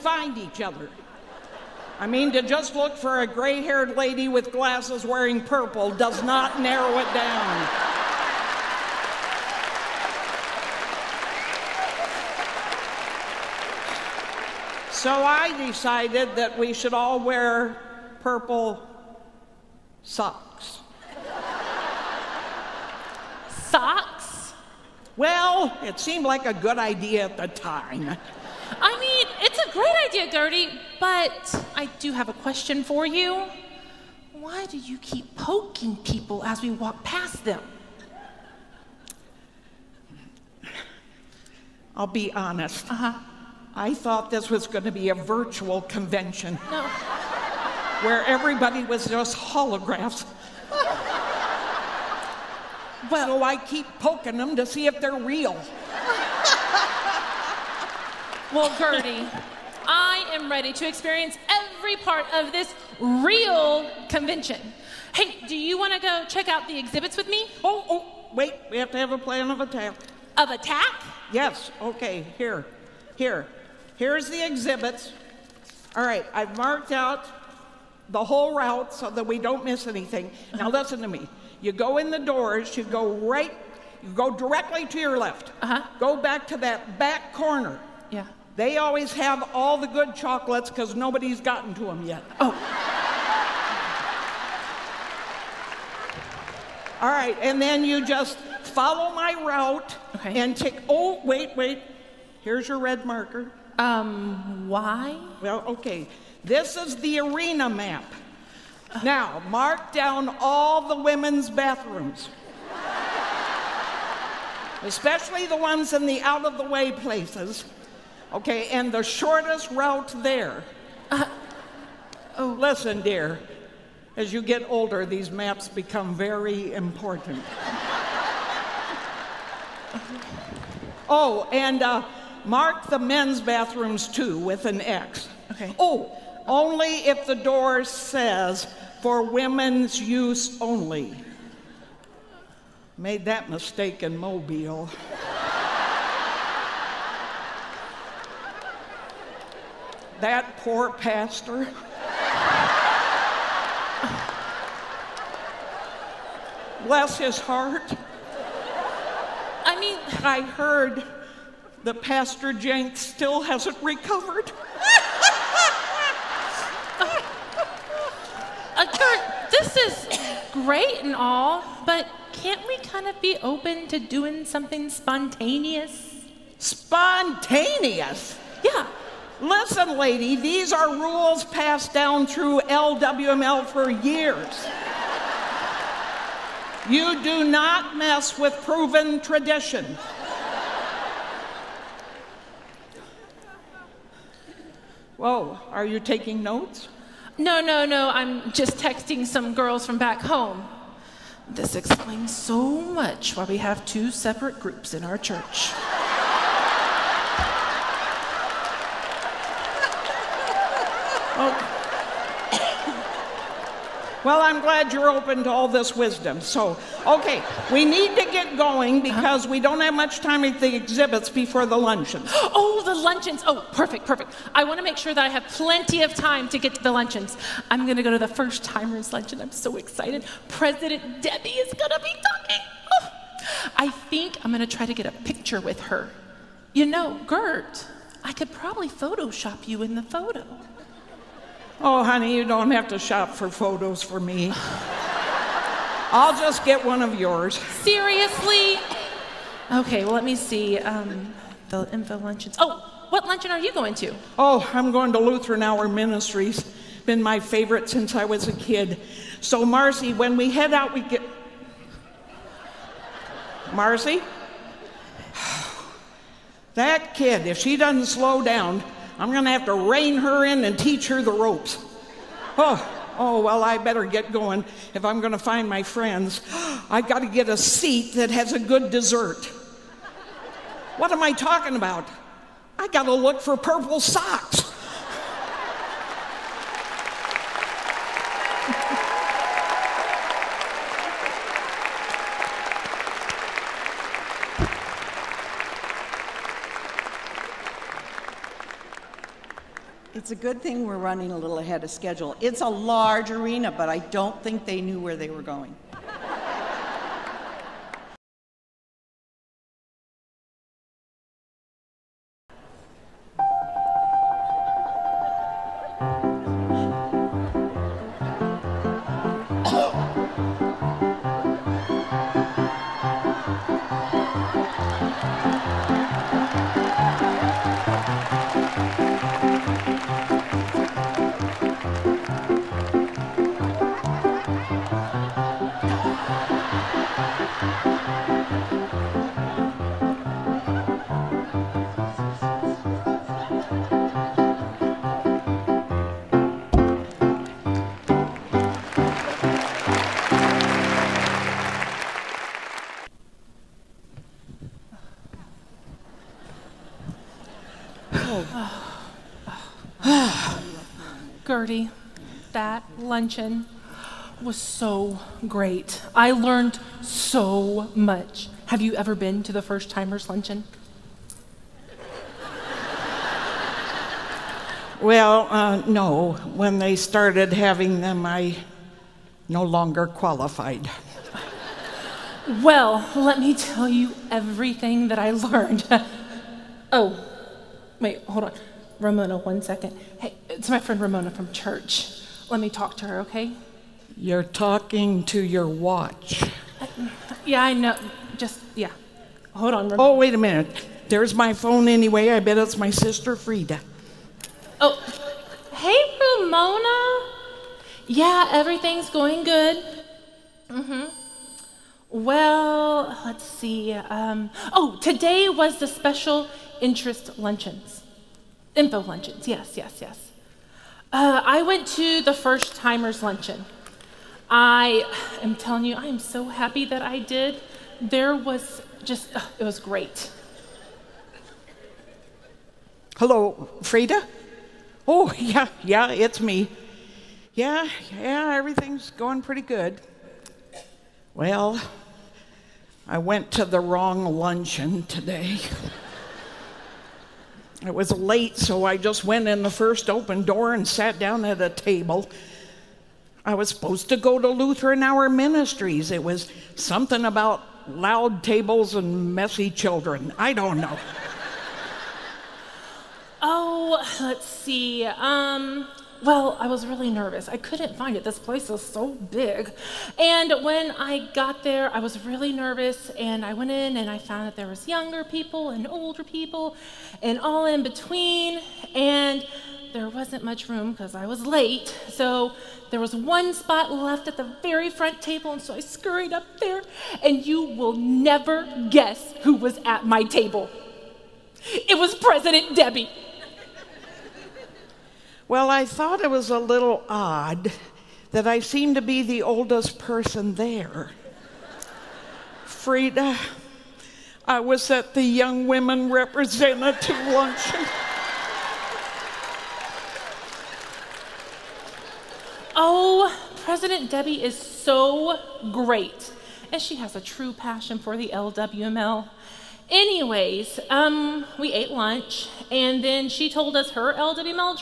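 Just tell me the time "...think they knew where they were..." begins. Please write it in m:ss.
5:04.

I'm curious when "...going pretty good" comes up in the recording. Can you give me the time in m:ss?
7:19.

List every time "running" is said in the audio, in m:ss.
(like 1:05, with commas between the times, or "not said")
5:00.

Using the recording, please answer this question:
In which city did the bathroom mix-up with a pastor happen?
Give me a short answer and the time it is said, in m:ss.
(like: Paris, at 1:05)
Mobile, at 2:24.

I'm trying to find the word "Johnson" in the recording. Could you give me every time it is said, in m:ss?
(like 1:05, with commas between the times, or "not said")
not said.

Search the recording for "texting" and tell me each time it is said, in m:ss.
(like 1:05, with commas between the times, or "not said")
3:18.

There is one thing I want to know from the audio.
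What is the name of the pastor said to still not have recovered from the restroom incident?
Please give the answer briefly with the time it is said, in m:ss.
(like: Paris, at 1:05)
Pastor Jenks, at 2:41.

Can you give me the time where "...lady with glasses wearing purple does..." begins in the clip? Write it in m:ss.
0:03.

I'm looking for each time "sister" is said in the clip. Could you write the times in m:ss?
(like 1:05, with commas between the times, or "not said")
6:42.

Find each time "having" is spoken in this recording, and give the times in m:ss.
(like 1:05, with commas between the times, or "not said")
6:17.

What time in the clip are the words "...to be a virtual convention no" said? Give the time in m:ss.
0:44.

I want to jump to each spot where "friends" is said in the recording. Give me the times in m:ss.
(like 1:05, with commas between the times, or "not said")
4:35, 6:30.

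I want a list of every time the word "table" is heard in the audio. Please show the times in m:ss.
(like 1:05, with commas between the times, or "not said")
7:31, 7:38, 8:05, 8:10.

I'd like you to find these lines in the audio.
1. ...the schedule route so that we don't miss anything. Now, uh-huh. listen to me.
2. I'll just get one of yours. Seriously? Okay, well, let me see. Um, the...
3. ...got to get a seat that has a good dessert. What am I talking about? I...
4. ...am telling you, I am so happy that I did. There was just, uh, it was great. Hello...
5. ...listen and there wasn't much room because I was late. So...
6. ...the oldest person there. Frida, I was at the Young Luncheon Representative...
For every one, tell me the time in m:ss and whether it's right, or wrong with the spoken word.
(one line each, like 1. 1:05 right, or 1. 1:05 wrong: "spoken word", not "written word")
1. 1:18 wrong: "whole", not "schedule"
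2. 4:06 right
3. 4:37 right
4. 7:05 right
5. 7:57 wrong: "between", not "listen"
6. 8:19 wrong: "Women", not "Luncheon".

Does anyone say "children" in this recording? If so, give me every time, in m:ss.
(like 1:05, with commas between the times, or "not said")
7:39.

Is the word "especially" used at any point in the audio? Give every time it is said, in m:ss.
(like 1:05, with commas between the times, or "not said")
1:54.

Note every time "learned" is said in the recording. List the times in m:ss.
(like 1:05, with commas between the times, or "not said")
6:06, 6:25.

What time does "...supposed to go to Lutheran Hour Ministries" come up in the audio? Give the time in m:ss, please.
7:33.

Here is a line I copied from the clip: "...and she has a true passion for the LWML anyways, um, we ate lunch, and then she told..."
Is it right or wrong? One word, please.
right.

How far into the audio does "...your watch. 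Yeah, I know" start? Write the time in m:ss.
6:35.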